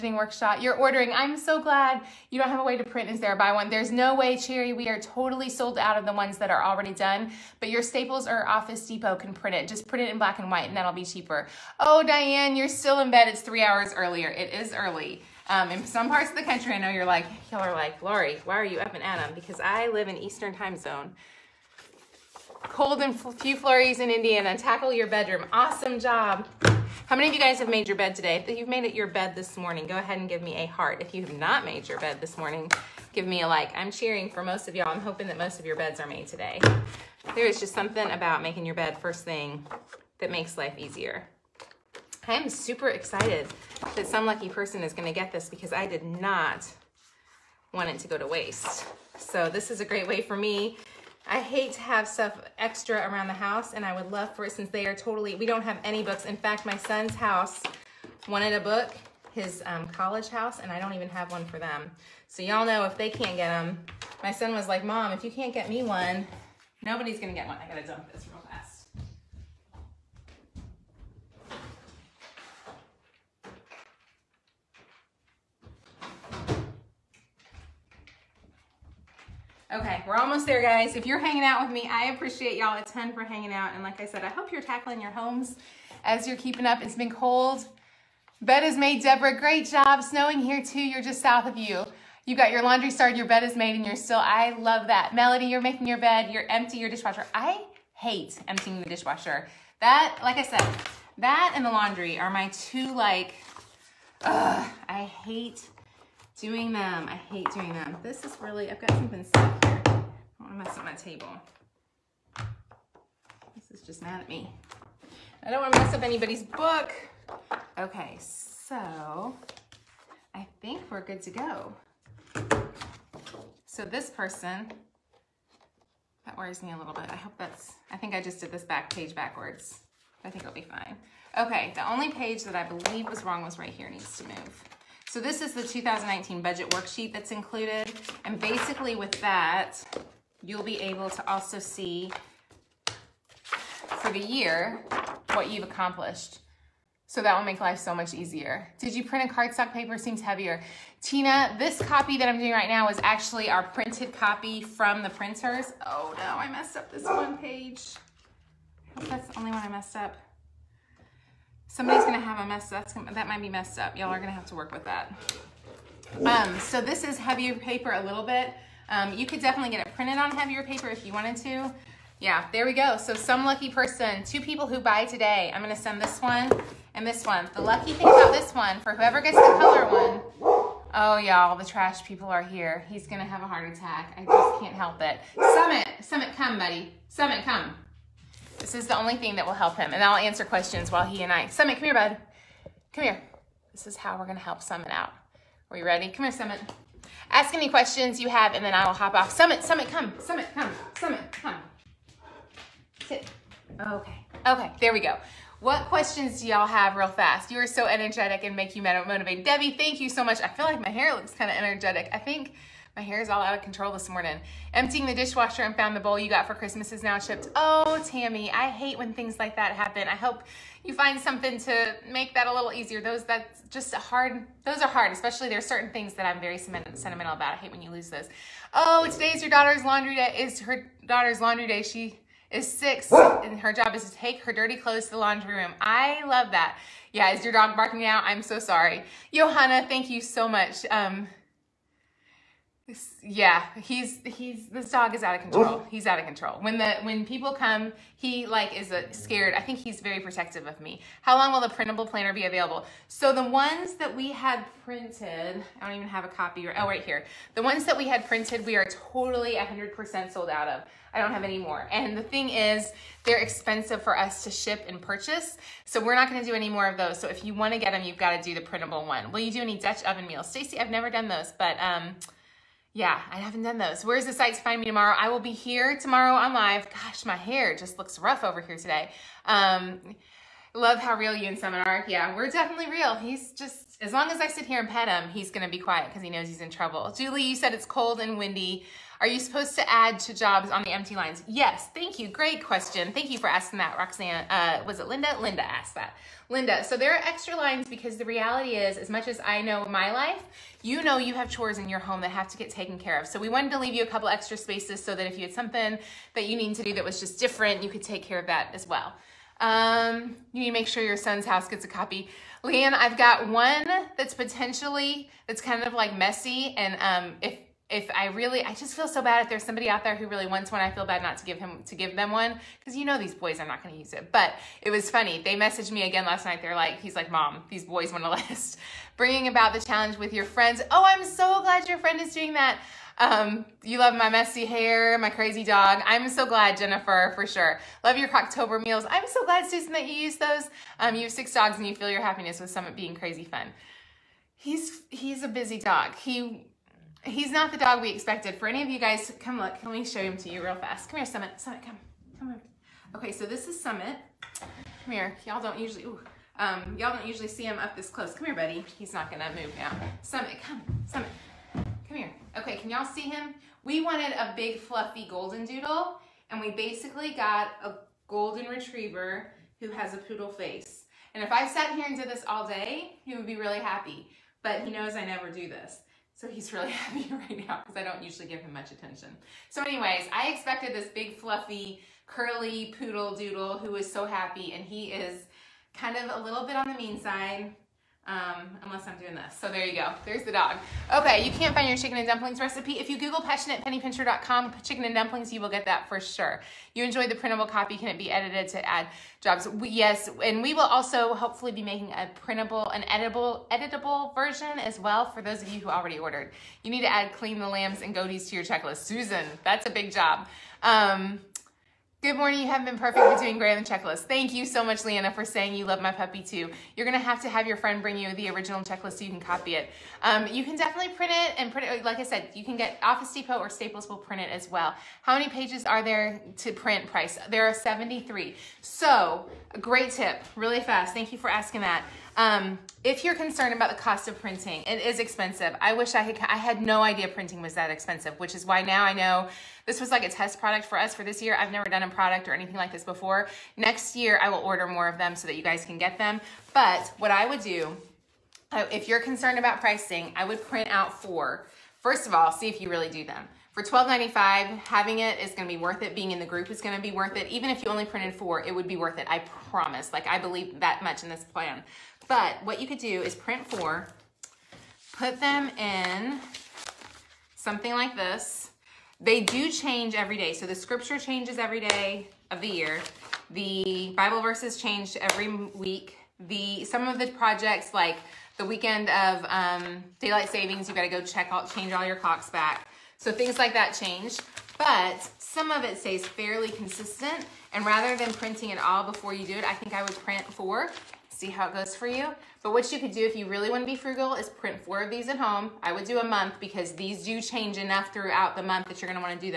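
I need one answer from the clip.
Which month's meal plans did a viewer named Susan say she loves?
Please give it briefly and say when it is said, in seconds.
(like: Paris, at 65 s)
October, at 338 s.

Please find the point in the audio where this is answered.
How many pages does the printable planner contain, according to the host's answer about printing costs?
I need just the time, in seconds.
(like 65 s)
427 s.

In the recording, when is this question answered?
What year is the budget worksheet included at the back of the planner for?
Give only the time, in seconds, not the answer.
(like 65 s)
135 s.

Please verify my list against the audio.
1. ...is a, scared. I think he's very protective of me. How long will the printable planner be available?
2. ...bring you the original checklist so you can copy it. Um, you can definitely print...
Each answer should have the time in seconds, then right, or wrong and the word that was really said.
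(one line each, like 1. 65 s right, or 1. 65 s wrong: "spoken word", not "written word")
1. 248 s right
2. 418 s right.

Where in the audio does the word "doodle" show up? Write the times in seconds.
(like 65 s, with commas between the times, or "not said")
365 s, 383 s.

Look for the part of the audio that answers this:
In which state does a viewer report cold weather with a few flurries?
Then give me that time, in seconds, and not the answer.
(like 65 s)
24 s.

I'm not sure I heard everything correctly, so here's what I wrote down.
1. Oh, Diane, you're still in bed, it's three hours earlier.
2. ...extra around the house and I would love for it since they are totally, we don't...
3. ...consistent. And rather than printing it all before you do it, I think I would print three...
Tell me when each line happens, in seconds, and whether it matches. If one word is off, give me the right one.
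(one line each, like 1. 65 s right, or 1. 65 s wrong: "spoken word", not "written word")
1. 11 s right
2. 52 s right
3. 486 s wrong: "four", not "three".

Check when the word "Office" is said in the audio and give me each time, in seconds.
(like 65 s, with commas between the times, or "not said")
8 s, 423 s.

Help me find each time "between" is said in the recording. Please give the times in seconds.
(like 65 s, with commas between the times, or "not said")
413 s.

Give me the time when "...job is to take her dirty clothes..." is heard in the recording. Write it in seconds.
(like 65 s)
233 s.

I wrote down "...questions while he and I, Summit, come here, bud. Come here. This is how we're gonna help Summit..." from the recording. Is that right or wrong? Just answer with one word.
right.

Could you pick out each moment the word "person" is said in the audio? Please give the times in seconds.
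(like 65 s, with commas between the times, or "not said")
44 s, 124 s, 173 s.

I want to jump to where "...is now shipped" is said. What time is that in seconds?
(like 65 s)
216 s.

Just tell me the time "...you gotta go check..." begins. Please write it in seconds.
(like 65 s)
480 s.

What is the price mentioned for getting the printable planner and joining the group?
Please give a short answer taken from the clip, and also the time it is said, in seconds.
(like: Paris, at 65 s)
$12.95, at 453 s.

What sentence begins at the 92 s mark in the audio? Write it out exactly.
You got your laundry started, your bed is made, and you're still, I love that.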